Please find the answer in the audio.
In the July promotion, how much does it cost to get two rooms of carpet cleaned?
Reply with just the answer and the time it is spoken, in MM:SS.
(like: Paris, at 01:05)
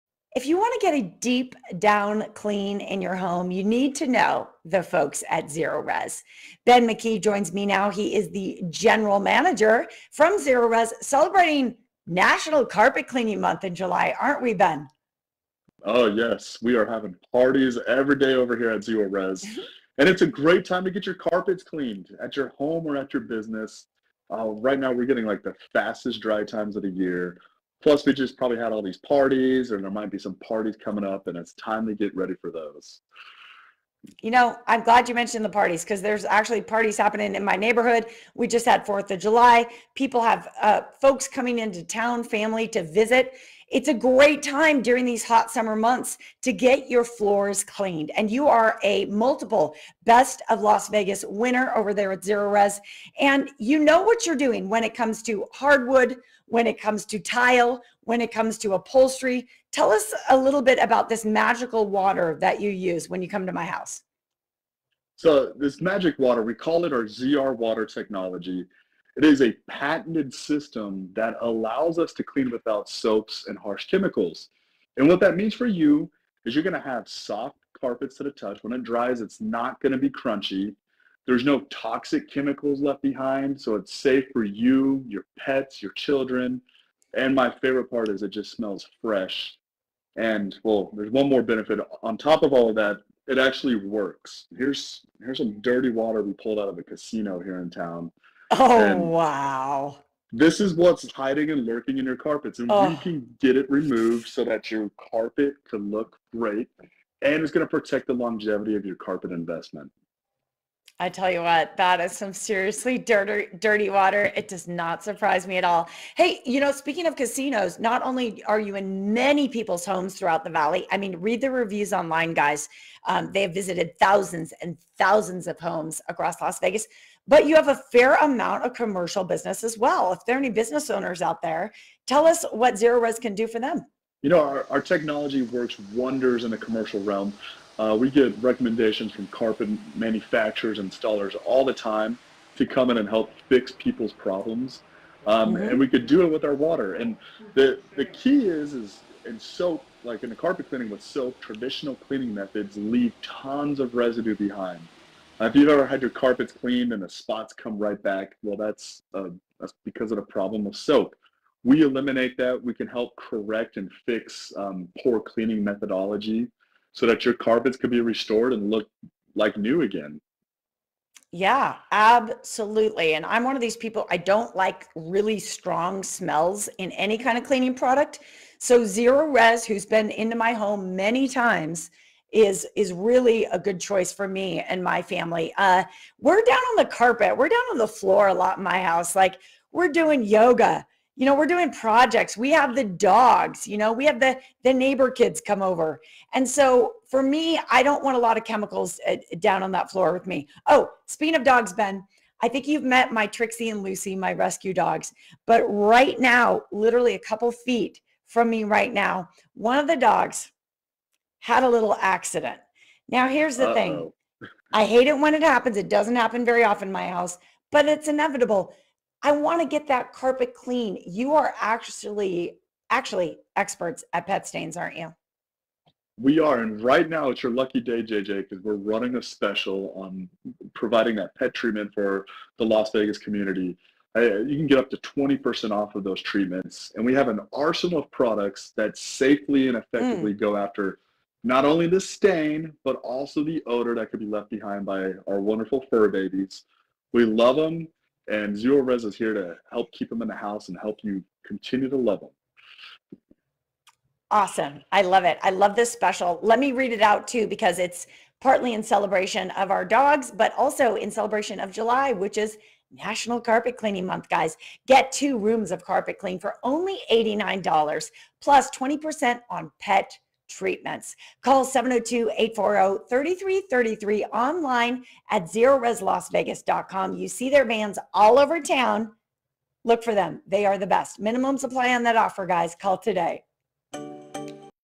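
$89, at 04:27.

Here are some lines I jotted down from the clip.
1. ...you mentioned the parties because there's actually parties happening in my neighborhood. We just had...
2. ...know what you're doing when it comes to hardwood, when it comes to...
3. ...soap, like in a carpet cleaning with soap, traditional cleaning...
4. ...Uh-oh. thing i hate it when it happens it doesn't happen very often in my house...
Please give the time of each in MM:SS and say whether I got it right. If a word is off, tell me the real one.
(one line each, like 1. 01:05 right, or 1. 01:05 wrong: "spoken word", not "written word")
1. 00:35 right
2. 00:53 right
3. 02:29 right
4. 03:33 right.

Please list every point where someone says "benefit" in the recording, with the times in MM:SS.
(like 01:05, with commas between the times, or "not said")
01:31.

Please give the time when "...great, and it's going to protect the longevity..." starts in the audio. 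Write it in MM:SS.
01:46.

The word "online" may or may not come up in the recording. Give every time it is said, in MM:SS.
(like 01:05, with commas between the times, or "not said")
02:01, 04:34.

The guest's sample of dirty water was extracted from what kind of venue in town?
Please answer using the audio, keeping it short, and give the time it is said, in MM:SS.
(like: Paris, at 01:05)
A casino, at 01:36.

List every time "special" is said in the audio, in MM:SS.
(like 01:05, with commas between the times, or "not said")
03:49, 04:15.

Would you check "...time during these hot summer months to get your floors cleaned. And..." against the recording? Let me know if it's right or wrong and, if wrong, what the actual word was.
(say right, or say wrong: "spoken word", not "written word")
right.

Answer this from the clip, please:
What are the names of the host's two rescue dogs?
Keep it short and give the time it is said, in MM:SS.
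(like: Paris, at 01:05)
Trixie and Lucy, at 03:23.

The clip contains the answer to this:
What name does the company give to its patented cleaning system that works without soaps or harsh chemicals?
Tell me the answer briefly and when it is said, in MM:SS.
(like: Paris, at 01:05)
ZR water technology, at 01:07.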